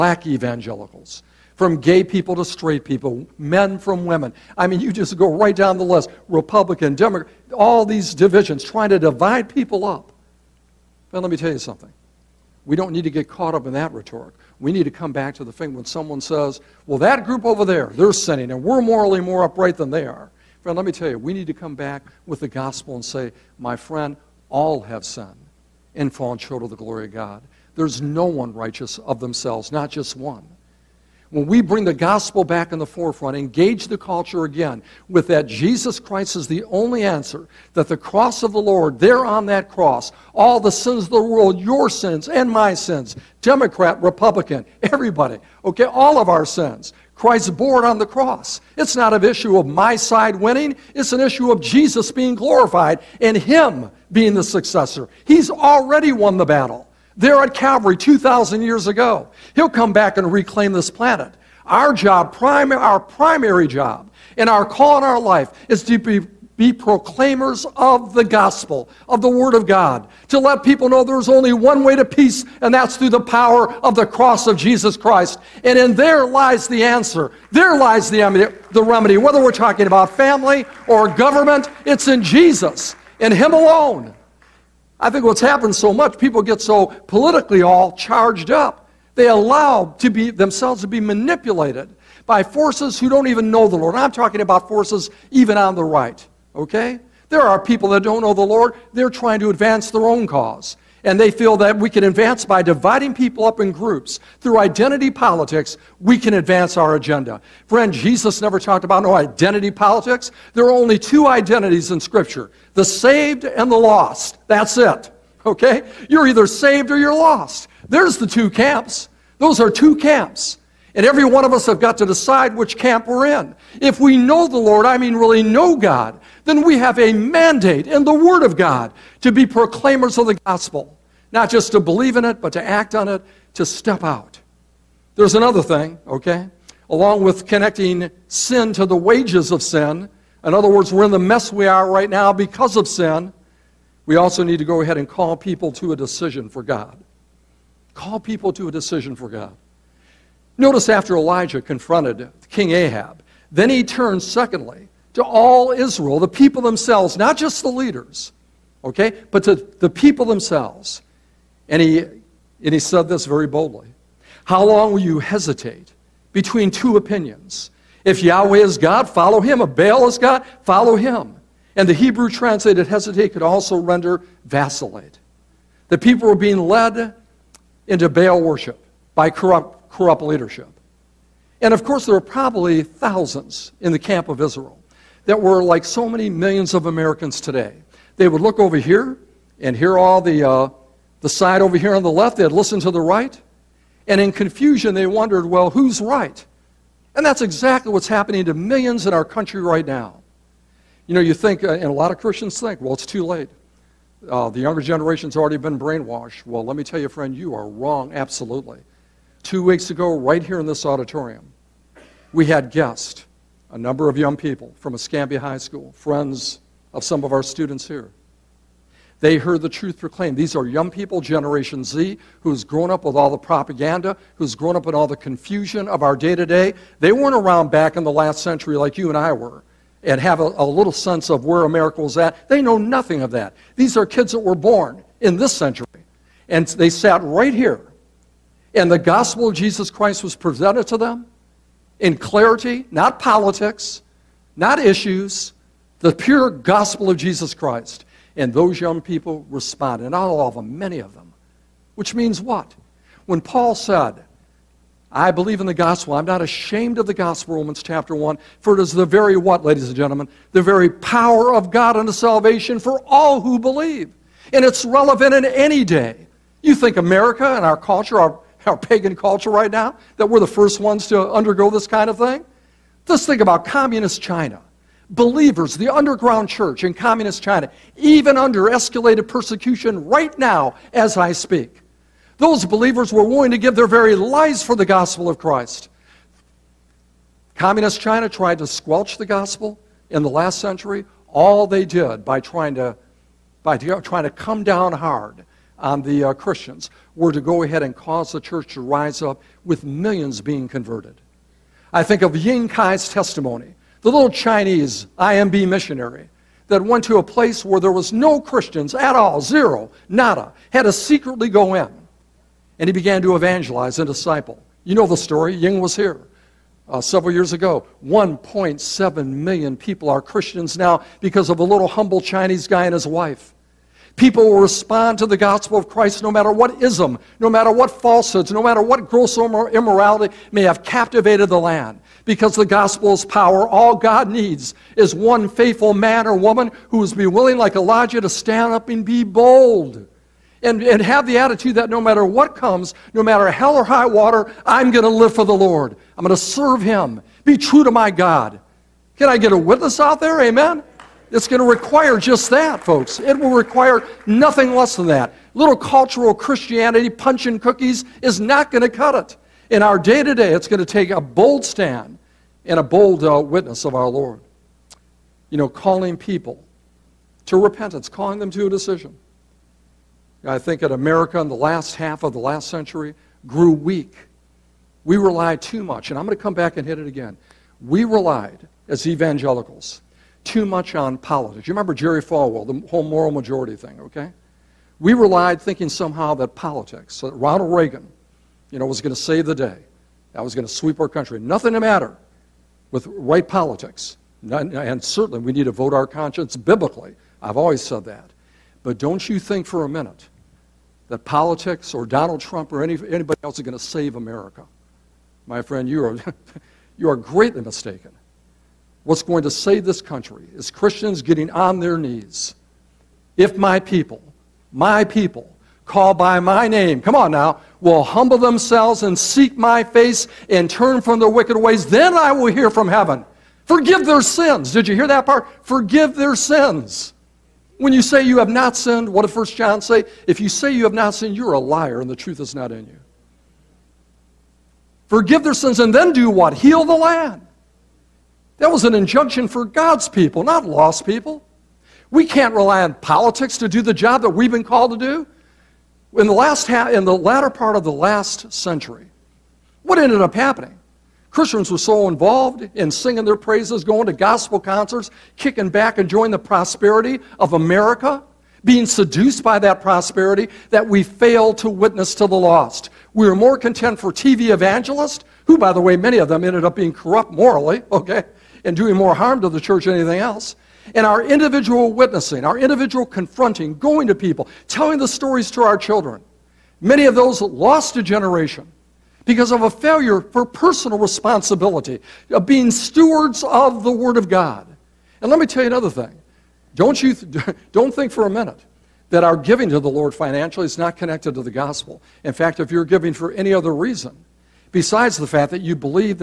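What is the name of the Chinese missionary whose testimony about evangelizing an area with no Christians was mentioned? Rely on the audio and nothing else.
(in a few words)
Ying Kai.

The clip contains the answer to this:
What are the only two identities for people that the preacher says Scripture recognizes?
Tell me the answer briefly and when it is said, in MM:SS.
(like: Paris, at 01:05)
The saved and the lost, at 01:52.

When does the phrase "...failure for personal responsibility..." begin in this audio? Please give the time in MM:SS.
07:59.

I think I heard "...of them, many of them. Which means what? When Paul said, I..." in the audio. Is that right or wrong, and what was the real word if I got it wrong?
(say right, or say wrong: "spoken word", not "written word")
right.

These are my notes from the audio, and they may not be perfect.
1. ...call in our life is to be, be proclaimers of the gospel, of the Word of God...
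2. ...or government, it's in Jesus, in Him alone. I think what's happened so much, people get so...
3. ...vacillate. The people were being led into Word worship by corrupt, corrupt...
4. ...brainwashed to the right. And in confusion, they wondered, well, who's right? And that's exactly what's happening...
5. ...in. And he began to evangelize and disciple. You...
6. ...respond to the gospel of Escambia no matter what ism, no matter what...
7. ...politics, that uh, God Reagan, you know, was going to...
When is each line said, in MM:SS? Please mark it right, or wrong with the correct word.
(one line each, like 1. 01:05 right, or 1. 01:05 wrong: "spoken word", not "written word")
1. 01:04 right
2. 01:20 right
3. 02:54 wrong: "Baal", not "Word"
4. 03:12 wrong: "listened", not "brainwashed"
5. 05:11 right
6. 05:24 wrong: "Christ", not "Escambia"
7. 06:26 wrong: "Ronald", not "God".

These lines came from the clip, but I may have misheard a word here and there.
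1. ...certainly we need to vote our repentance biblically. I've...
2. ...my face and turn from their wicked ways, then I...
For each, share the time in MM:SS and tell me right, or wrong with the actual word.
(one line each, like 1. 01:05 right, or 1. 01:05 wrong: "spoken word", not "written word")
1. 06:35 wrong: "conscience", not "repentance"
2. 06:59 right.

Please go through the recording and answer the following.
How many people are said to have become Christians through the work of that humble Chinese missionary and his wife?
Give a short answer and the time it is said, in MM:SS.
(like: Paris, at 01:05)
1.7 million, at 05:18.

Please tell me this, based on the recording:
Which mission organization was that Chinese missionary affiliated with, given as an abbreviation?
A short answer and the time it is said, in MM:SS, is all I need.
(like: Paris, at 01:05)
IMB, at 05:05.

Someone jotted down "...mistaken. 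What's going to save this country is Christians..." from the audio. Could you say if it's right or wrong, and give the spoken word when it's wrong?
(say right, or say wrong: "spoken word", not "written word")
right.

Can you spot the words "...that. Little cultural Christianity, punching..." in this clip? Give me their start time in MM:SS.
05:55.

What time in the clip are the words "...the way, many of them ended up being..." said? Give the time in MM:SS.
07:45.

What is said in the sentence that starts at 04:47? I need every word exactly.
Communist China tried to squelch the gospel in the last century.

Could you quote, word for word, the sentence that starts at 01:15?
And in there lies the answer.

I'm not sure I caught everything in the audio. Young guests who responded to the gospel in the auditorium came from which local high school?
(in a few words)
Escambia High School.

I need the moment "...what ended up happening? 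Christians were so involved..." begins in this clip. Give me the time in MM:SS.
07:29.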